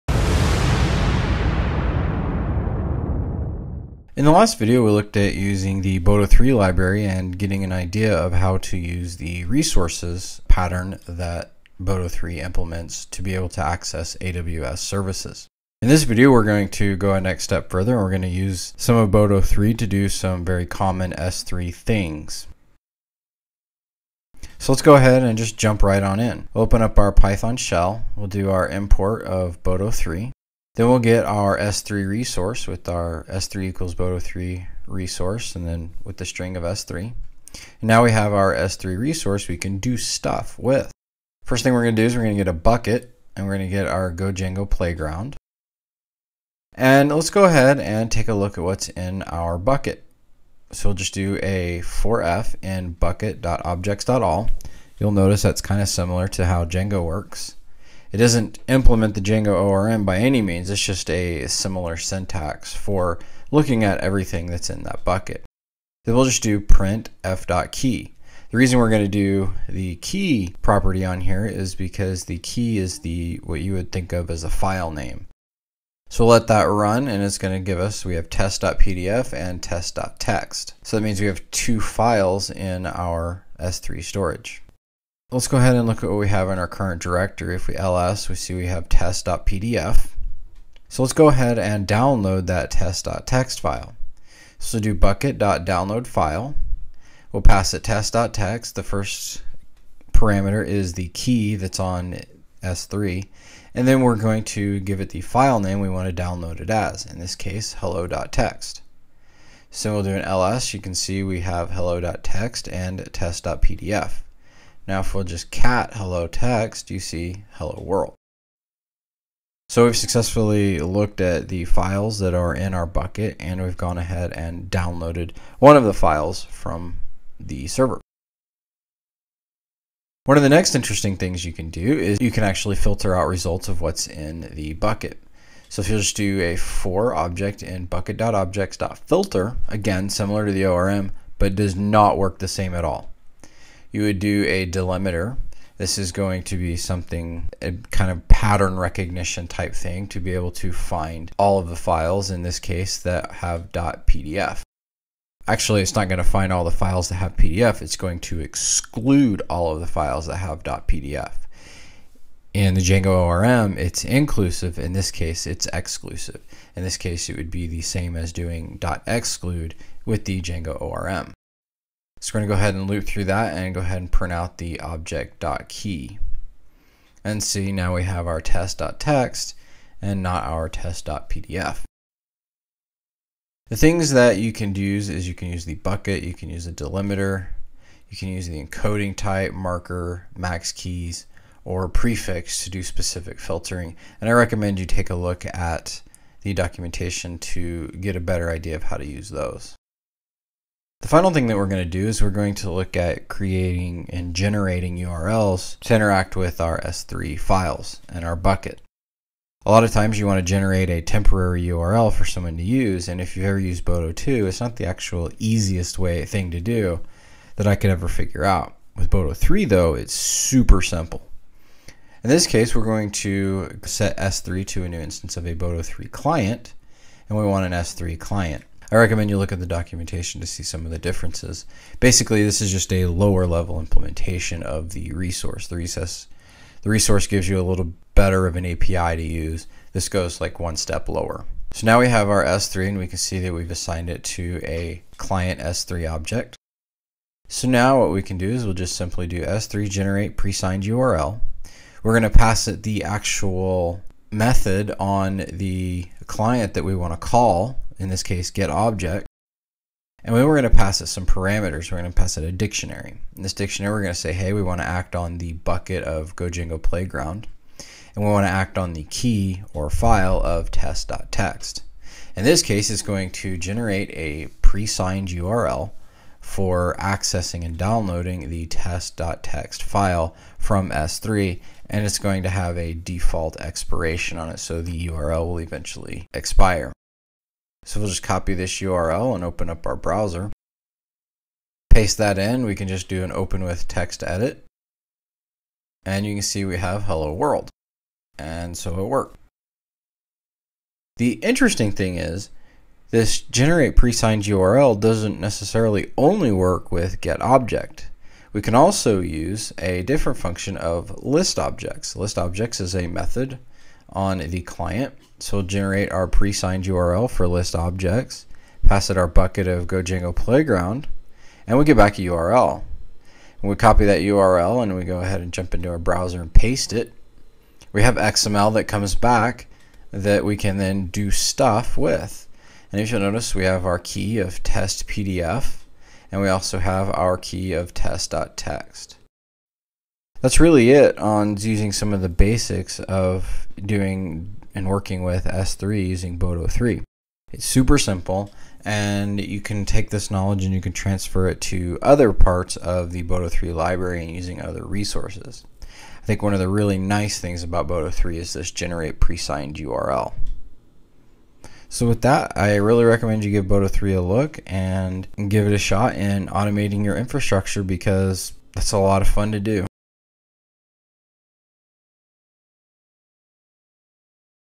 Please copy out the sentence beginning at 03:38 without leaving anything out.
With Boto 3 though, it's super simple.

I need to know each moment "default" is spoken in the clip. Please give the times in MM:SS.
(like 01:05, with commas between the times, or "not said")
04:42.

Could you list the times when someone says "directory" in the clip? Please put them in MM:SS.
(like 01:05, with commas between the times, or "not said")
01:27.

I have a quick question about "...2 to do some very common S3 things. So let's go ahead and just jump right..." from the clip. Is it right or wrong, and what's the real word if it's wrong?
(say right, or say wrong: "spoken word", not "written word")
wrong: "3", not "2".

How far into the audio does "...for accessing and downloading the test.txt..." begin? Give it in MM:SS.
04:36.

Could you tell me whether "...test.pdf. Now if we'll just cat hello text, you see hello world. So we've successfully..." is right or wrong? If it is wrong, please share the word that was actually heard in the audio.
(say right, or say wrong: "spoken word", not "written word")
right.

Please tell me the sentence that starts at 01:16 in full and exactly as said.
So we'll let that run and it's going to give us, we have test.pdf and text.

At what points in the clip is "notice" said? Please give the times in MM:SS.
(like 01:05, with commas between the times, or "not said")
00:55, 05:33.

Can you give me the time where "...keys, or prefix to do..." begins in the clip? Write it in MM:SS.
03:10.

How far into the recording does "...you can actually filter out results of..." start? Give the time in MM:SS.
02:12.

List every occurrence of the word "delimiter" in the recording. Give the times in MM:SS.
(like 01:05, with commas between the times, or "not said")
02:24, 03:06.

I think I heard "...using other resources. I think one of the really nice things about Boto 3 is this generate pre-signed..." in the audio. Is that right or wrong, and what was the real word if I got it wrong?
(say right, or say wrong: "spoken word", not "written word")
right.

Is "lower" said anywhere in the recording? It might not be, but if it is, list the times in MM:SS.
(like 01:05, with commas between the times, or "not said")
03:53, 04:01.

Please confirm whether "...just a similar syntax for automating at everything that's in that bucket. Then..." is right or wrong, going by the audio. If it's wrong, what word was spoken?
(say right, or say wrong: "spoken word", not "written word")
wrong: "looking", not "automating".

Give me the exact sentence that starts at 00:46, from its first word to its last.
And let's go ahead and take a look at what's in our bucket.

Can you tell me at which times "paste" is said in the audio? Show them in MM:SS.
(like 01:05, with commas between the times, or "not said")
04:51, 05:26.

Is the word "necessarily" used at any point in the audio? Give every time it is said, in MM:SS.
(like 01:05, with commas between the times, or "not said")
05:05.